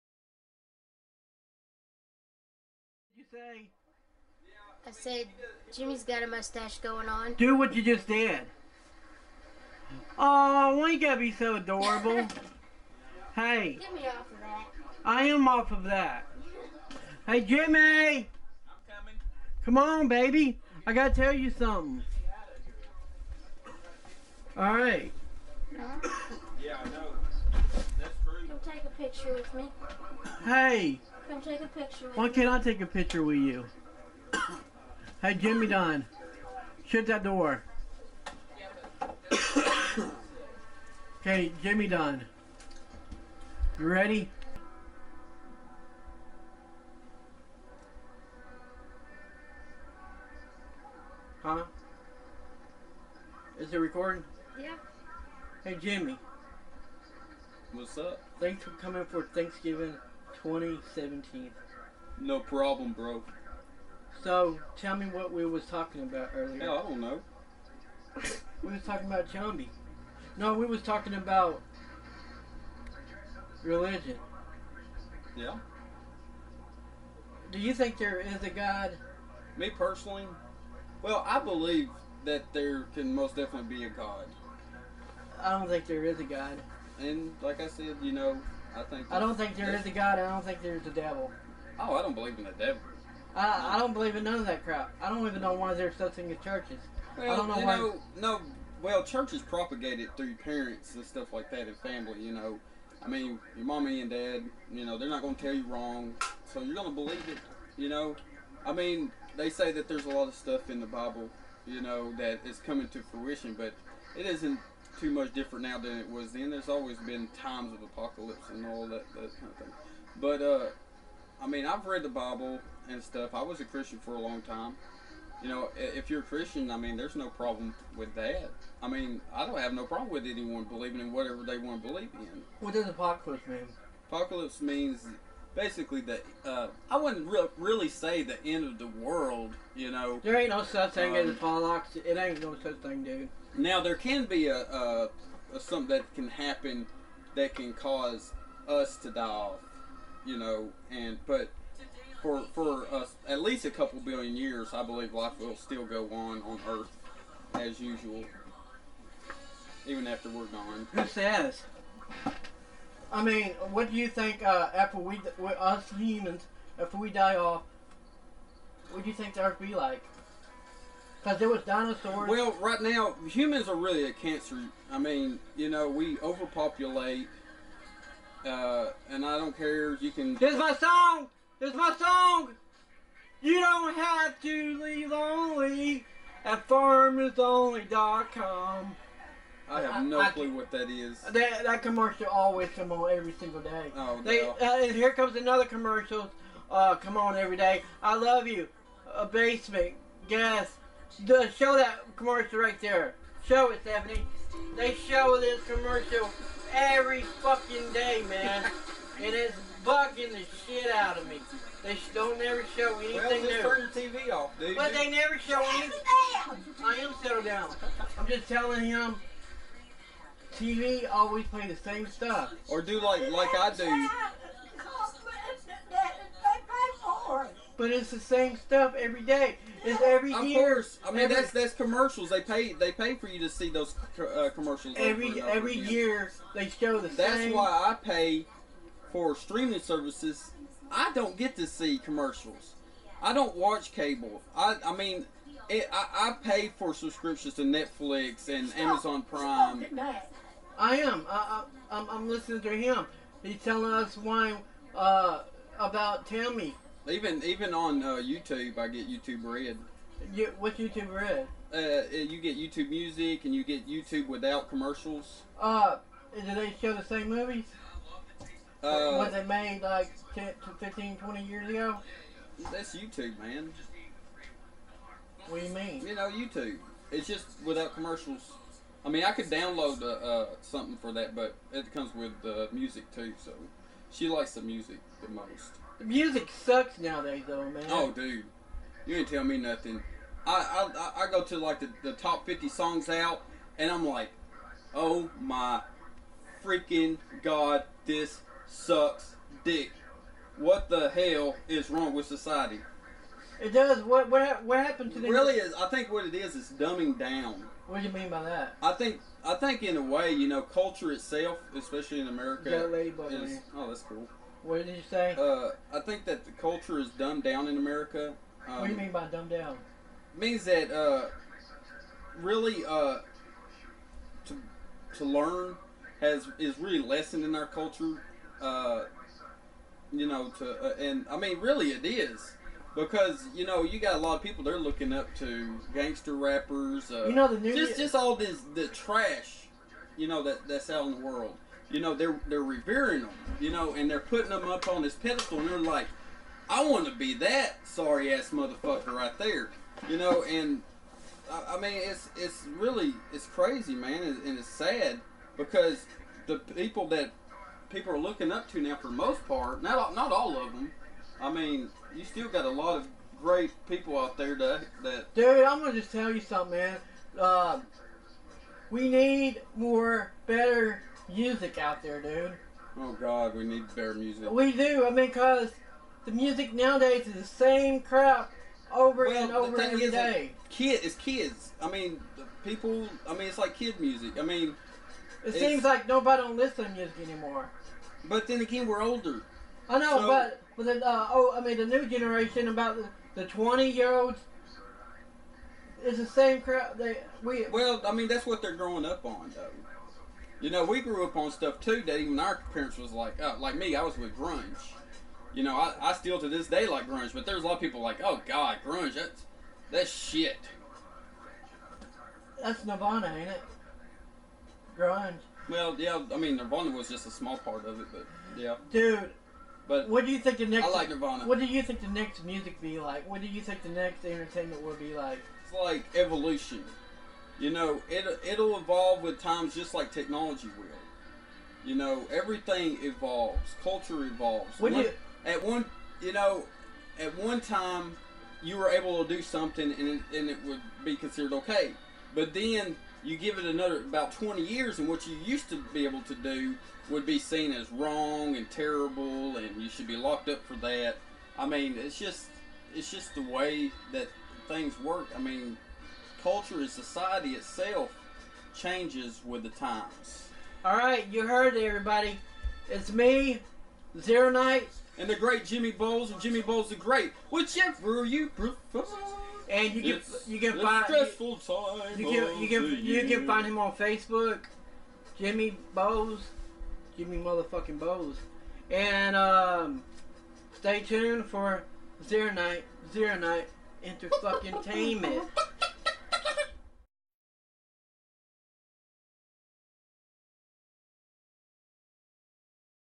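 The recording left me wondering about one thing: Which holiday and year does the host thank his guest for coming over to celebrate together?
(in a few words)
Thanksgiving 2017.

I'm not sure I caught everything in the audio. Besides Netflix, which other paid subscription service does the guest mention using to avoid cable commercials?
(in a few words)
Amazon Prime.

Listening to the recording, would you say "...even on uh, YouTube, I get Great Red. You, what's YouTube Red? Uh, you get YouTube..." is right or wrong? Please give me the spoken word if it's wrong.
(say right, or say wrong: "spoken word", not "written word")
wrong: "YouTube", not "Great".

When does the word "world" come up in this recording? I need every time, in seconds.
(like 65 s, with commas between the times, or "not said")
138 s, 341 s.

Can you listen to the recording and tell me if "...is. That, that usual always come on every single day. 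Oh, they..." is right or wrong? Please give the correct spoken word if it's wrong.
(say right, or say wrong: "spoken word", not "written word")
wrong: "commercial", not "usual".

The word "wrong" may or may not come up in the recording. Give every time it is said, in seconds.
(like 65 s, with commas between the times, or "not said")
105 s, 301 s, 447 s.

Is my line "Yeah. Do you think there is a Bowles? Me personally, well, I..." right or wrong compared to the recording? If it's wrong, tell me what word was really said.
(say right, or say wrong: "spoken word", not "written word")
wrong: "God", not "Bowles".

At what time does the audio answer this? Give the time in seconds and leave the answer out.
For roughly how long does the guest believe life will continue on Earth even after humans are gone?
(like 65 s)
153 s.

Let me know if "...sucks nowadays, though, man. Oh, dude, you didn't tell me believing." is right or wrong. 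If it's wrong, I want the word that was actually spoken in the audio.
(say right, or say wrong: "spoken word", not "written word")
wrong: "nothing", not "believing".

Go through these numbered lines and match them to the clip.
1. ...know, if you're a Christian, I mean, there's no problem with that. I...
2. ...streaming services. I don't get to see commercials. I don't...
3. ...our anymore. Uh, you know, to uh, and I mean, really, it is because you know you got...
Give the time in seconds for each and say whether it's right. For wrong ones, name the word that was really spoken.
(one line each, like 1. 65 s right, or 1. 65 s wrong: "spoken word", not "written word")
1. 125 s right
2. 239 s right
3. 327 s wrong: "culture", not "anymore".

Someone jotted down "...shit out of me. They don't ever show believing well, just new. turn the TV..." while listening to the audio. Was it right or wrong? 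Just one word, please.
wrong.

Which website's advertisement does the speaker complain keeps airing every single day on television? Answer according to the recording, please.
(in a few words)
farmersonly.com.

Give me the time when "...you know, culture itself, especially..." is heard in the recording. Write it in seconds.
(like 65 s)
310 s.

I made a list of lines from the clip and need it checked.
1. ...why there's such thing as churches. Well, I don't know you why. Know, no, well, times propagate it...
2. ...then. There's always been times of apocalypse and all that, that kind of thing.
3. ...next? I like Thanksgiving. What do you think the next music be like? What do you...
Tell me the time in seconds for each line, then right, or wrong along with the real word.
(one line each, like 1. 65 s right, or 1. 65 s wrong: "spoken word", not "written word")
1. 95 s wrong: "churches", not "times"
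2. 116 s right
3. 420 s wrong: "Nirvana", not "Thanksgiving".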